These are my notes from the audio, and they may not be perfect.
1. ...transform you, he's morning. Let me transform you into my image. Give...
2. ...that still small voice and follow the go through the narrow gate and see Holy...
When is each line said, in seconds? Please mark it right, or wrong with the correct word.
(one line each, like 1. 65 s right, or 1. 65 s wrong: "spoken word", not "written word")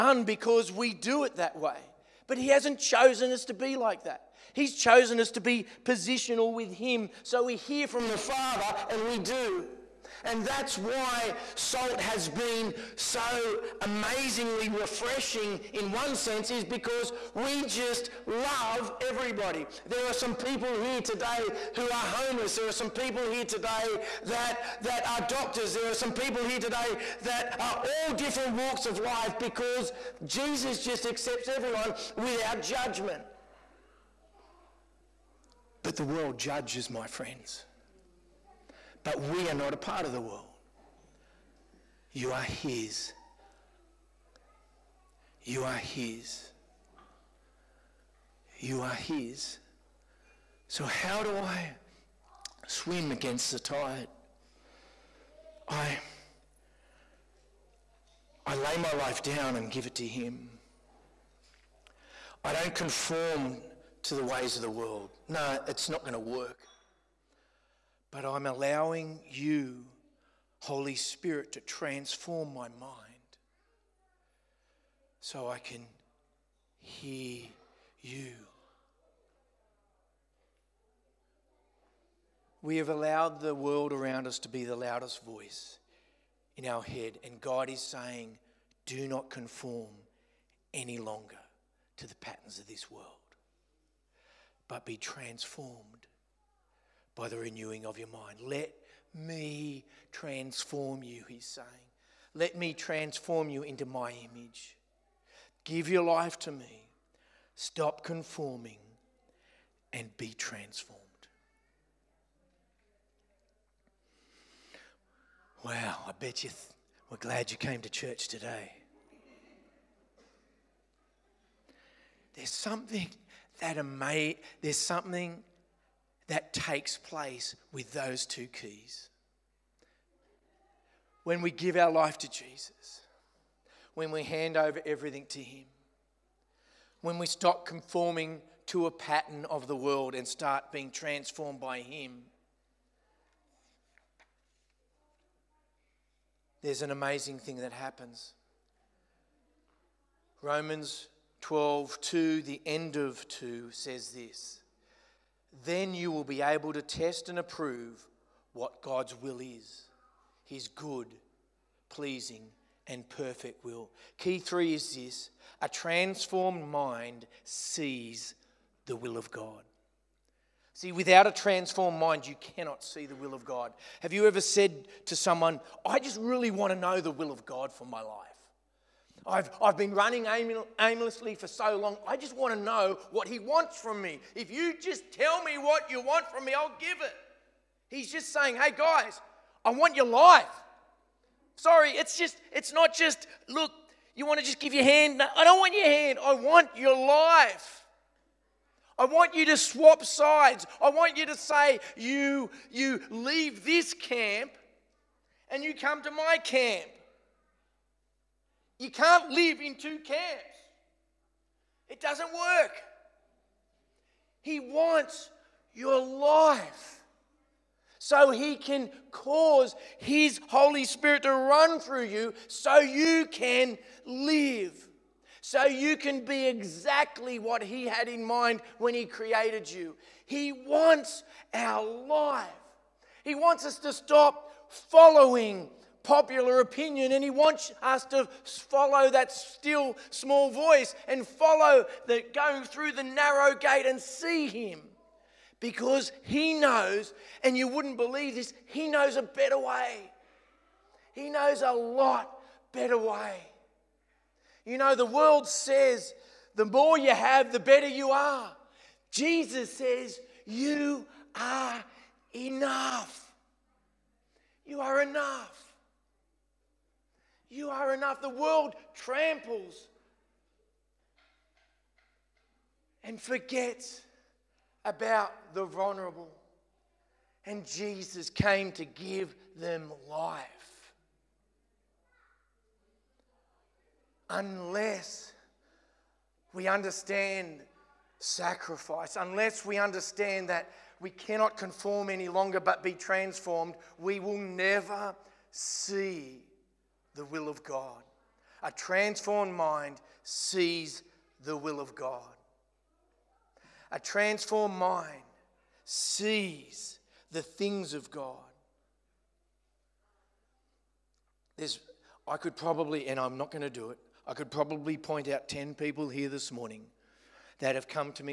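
1. 100 s wrong: "saying", not "morning"
2. 239 s wrong: "Him", not "Holy".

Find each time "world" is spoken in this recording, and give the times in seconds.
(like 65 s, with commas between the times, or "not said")
36 s, 40 s, 64 s, 83 s, 92 s, 139 s, 255 s, 268 s.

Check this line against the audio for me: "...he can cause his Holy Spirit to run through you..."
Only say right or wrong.
right.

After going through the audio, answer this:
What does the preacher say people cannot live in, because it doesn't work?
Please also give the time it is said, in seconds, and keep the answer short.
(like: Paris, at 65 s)
two camps, at 209 s.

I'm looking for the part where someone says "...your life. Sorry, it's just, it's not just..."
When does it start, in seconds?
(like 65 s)
189 s.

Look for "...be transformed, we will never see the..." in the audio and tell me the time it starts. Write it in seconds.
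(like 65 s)
292 s.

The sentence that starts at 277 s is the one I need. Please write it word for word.
And Jesus came to give them life.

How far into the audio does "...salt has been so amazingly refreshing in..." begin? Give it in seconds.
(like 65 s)
11 s.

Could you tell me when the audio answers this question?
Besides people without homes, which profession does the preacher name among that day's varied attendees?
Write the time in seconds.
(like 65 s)
25 s.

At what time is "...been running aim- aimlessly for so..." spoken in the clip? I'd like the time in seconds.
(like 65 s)
179 s.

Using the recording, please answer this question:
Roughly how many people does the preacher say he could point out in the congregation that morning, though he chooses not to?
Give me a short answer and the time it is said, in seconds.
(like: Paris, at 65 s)
10, at 315 s.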